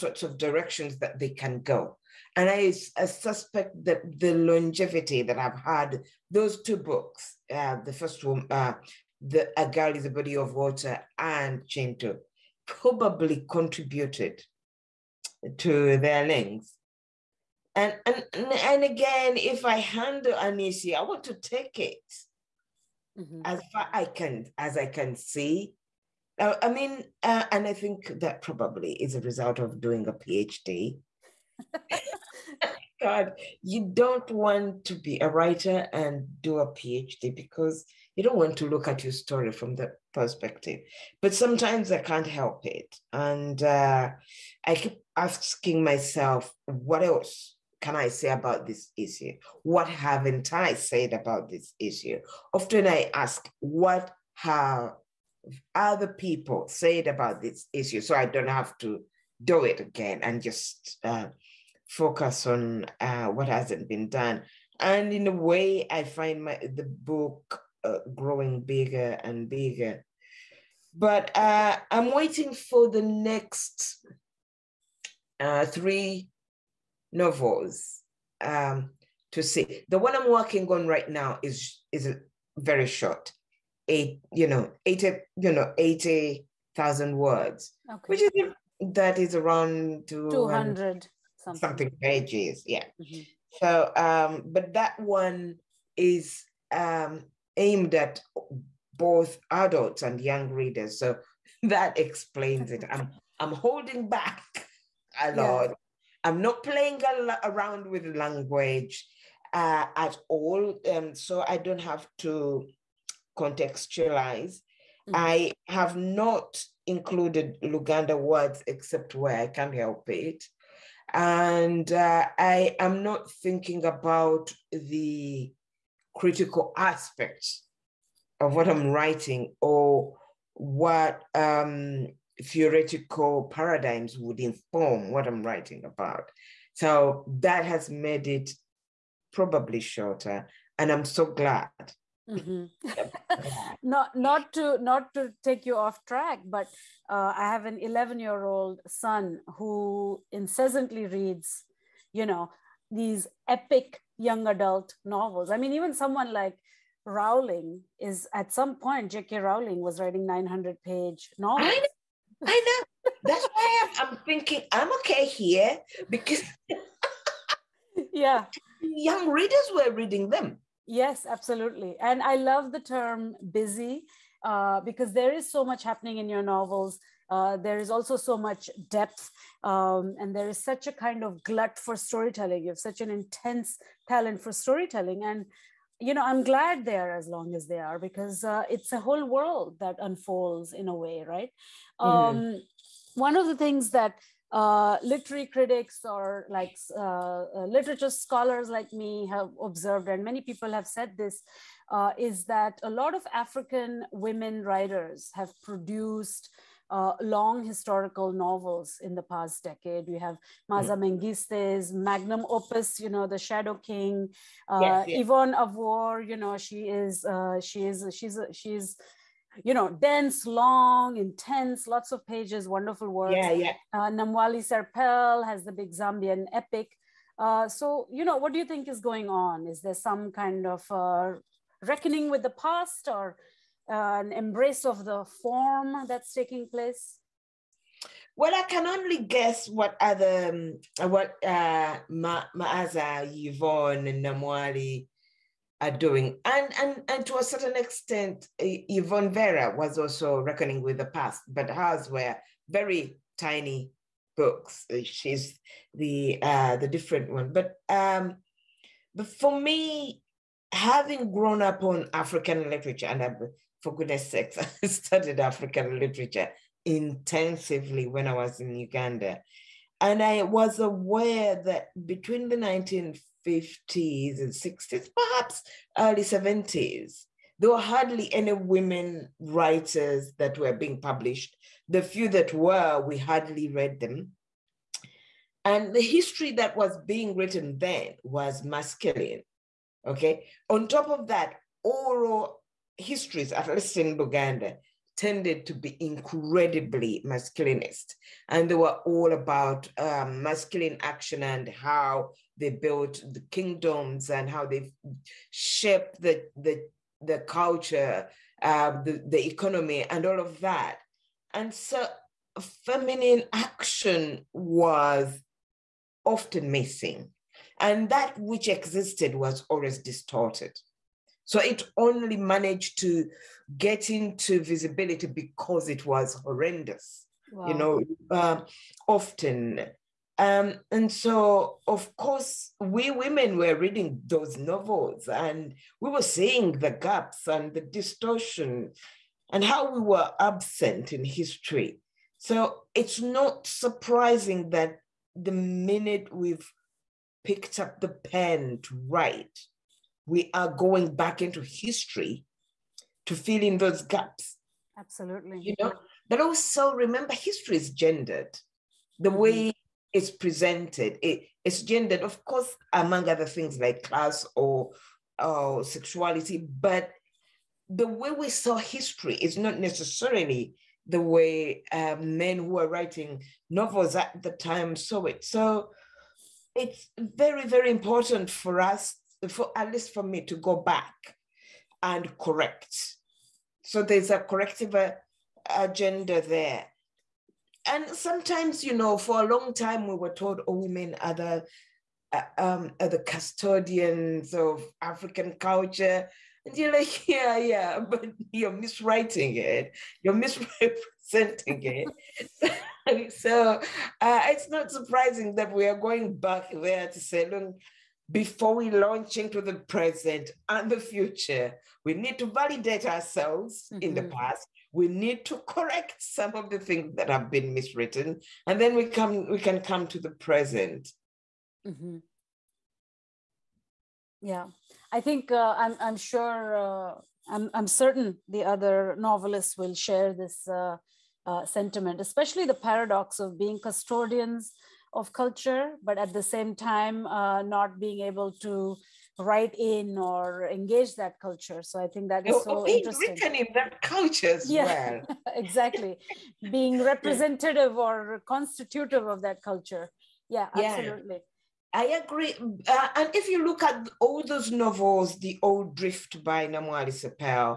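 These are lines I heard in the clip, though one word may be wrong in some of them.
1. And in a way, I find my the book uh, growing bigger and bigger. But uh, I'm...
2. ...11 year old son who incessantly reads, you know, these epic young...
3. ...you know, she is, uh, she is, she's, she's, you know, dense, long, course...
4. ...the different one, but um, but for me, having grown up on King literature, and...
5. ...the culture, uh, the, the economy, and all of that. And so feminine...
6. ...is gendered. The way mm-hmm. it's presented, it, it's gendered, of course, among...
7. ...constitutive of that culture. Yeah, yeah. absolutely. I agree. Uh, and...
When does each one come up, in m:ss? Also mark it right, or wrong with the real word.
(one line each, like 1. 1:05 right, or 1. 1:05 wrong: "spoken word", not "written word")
1. 1:04 right
2. 2:27 right
3. 3:36 wrong: "intense", not "course"
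4. 4:16 wrong: "African", not "King"
5. 5:07 right
6. 5:57 right
7. 7:28 right.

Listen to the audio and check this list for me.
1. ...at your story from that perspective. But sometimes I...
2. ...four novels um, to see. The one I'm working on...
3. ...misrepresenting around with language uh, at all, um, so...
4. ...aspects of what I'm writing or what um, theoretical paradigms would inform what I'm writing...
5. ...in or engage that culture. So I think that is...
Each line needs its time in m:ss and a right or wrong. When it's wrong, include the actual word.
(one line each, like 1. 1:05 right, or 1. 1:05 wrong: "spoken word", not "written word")
1. 0:38 right
2. 1:15 wrong: "three", not "four"
3. 1:46 wrong: "playing", not "misrepresenting"
4. 2:06 right
5. 7:19 right.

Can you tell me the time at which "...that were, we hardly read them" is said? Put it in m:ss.
4:42.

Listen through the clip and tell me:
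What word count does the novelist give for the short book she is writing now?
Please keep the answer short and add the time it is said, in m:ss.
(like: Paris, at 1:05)
80,000 words, at 1:25.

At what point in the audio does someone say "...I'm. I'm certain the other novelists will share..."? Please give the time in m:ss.
7:07.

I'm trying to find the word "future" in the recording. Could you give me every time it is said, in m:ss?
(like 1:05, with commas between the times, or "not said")
6:50.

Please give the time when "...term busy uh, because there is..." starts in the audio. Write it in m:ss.
2:52.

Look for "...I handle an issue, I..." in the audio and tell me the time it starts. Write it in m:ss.
0:19.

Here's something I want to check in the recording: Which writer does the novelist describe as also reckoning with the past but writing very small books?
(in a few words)
Yvonne Vera.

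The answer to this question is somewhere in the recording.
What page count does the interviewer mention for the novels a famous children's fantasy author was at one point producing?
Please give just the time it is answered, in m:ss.
2:40.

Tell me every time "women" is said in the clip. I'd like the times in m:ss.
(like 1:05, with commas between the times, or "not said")
3:24, 4:38, 5:33, 6:30.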